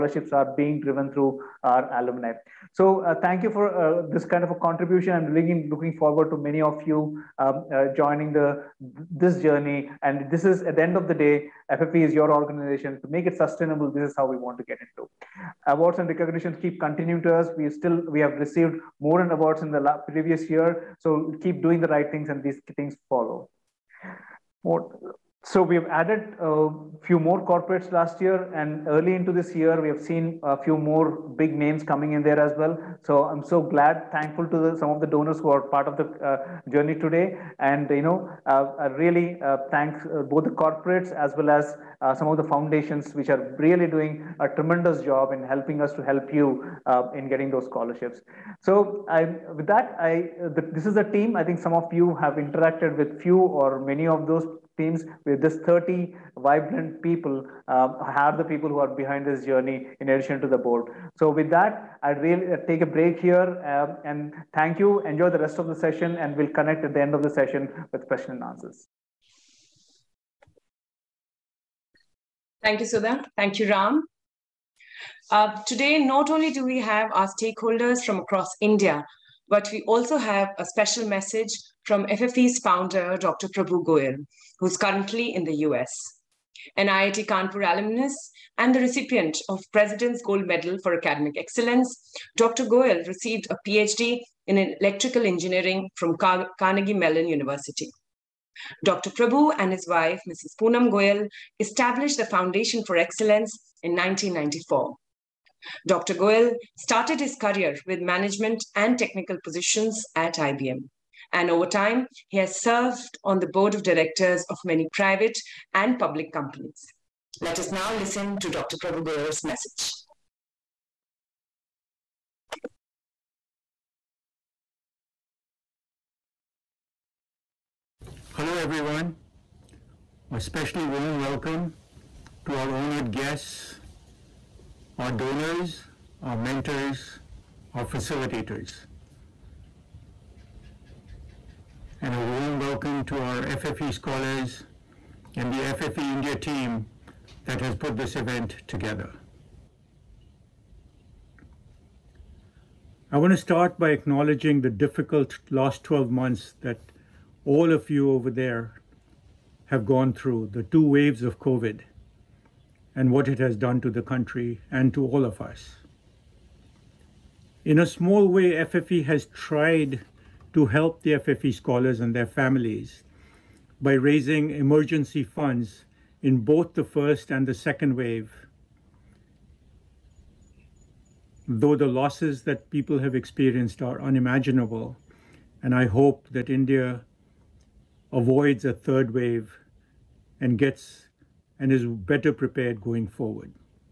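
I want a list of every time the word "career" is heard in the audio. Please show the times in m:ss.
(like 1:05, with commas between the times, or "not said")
1:47.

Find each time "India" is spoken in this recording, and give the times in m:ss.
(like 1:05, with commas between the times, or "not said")
1:18, 2:26, 3:06.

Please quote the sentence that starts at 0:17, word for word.
We still we have received more and awards in the previous year.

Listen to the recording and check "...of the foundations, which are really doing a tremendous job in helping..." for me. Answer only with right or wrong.
right.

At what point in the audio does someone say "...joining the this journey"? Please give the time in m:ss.
0:07.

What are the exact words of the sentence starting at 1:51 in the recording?
And over time, he has served on the board of directors of many private and public companies.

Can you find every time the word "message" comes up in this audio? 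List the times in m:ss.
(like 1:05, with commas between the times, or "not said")
1:21, 1:59.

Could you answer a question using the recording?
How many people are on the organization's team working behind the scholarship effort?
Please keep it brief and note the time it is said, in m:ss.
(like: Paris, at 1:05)
30, at 0:55.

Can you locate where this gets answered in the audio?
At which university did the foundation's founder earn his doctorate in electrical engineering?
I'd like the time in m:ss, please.
1:36.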